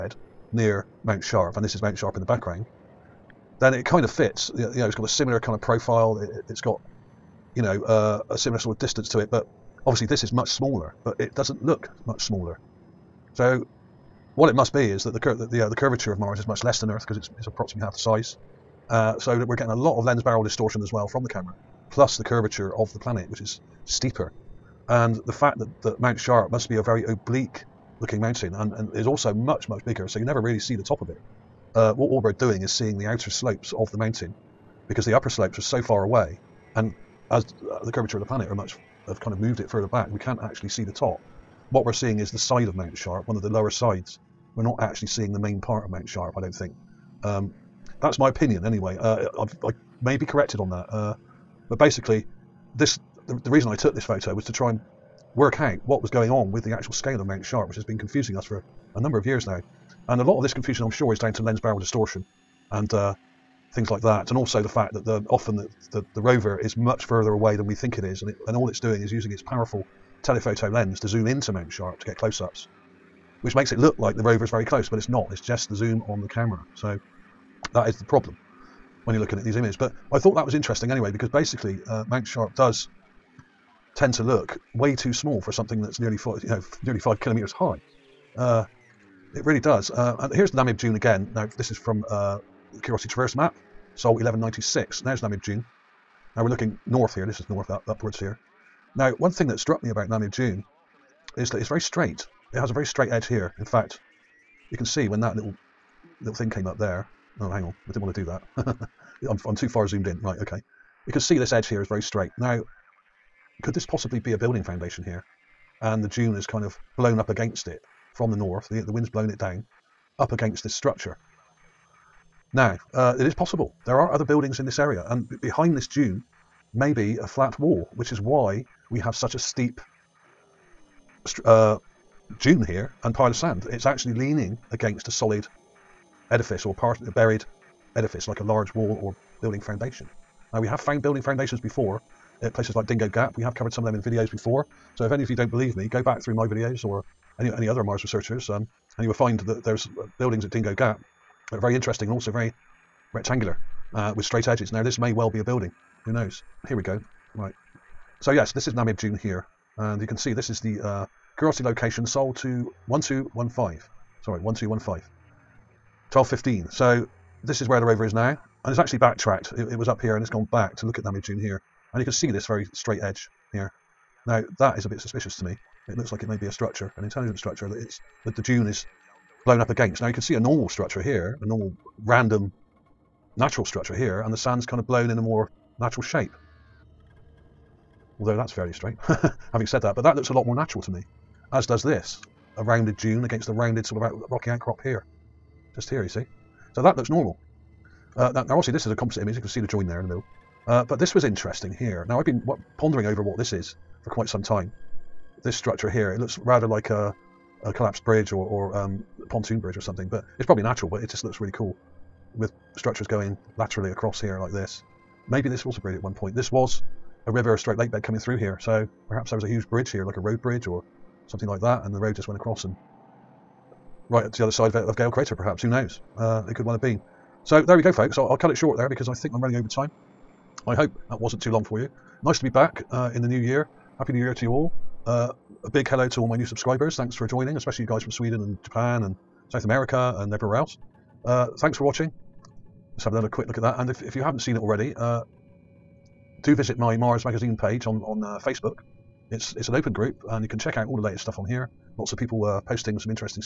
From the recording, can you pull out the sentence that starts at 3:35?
Maybe this was a bridge at one point.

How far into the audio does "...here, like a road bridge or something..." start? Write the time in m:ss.
3:39.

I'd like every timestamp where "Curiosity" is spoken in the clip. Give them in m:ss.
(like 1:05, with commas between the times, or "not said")
1:32, 2:41.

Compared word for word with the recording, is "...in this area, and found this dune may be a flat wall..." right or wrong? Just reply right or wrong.
wrong.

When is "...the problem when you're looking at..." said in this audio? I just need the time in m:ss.
1:17.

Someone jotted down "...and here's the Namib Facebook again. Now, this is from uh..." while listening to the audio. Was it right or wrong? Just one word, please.
wrong.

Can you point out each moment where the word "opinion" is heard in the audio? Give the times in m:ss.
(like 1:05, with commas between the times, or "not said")
0:48.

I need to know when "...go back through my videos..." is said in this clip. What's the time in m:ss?
2:25.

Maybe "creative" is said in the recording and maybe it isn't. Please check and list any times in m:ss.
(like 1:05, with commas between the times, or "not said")
not said.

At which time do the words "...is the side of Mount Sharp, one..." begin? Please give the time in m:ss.
0:42.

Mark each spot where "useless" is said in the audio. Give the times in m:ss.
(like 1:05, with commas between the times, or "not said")
not said.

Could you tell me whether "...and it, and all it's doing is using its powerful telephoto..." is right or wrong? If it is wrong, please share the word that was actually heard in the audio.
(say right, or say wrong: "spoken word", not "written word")
right.